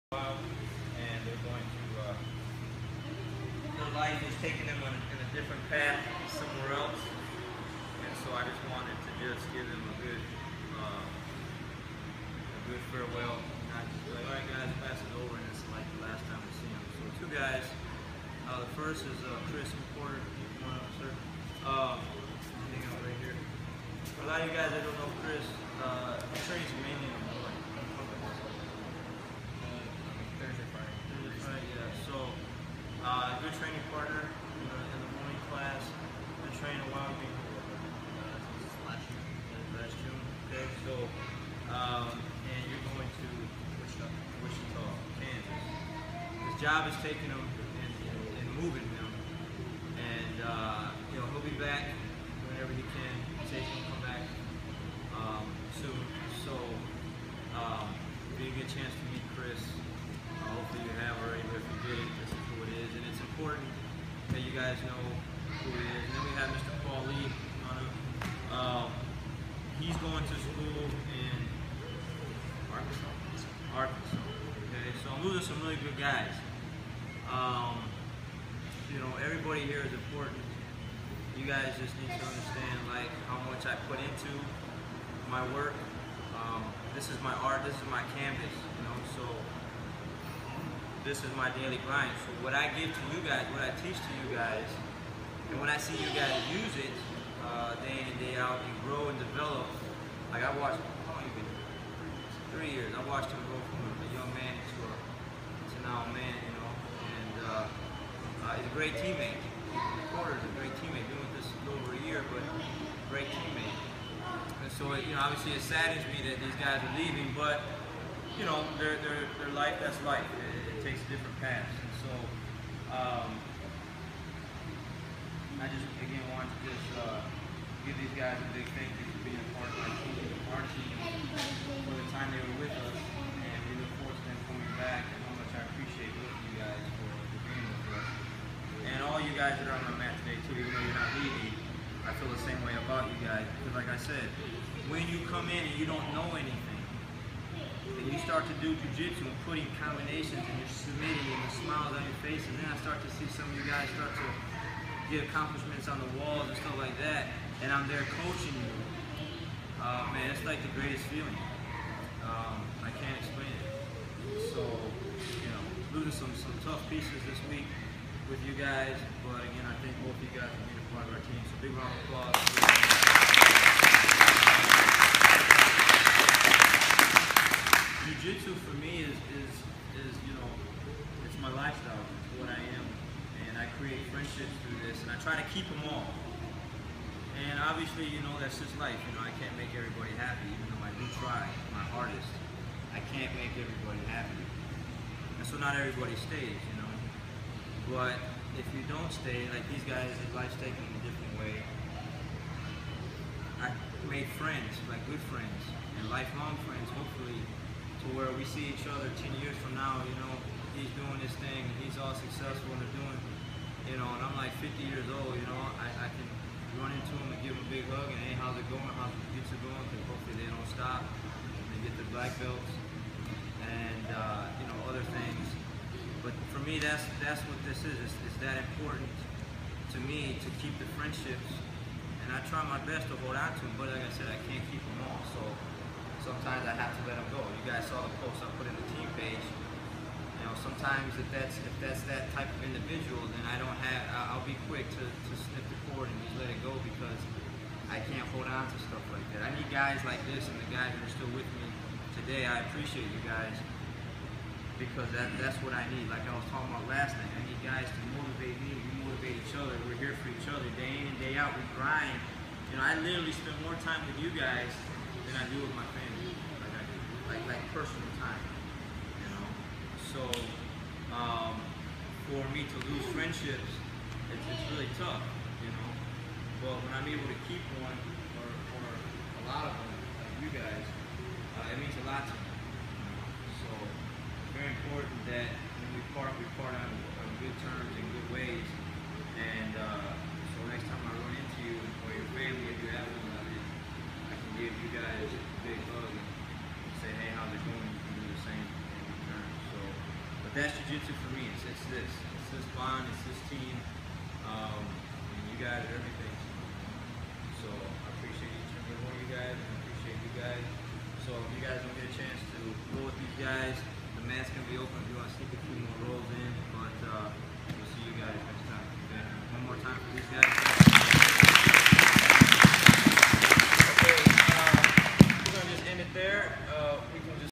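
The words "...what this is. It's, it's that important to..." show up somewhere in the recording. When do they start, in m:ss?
3:47.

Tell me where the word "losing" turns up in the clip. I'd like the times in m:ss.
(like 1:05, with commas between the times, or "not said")
1:15, 2:45.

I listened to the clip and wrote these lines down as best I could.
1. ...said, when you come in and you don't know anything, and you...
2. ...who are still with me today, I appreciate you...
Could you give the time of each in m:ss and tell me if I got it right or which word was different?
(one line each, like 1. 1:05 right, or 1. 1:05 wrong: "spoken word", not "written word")
1. 2:24 right
2. 4:10 right.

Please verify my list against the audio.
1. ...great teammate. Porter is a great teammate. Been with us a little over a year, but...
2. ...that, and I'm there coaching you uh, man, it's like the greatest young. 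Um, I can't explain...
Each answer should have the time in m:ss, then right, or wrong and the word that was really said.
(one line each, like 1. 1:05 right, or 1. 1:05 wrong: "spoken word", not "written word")
1. 1:48 right
2. 2:37 wrong: "feeling", not "young".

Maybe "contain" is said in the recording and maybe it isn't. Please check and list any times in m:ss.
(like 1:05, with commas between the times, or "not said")
not said.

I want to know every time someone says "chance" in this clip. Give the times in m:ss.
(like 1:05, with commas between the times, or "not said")
0:58, 5:12.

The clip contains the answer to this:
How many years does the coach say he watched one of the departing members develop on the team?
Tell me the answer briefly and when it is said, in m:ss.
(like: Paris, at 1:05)
3, at 1:42.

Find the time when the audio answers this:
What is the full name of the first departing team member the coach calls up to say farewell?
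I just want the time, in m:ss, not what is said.
0:19.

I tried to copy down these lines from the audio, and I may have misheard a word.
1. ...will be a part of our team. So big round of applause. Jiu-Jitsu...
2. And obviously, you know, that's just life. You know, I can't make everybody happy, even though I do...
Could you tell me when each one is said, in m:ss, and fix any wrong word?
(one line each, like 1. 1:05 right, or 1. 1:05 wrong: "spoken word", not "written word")
1. 2:50 right
2. 3:07 right.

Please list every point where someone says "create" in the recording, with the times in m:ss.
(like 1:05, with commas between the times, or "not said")
3:03.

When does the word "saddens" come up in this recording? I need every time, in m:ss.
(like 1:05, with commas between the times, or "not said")
1:55.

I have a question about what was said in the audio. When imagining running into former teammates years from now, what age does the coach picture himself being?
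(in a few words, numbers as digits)
50.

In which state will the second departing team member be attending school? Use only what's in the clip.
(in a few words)
Arkansas.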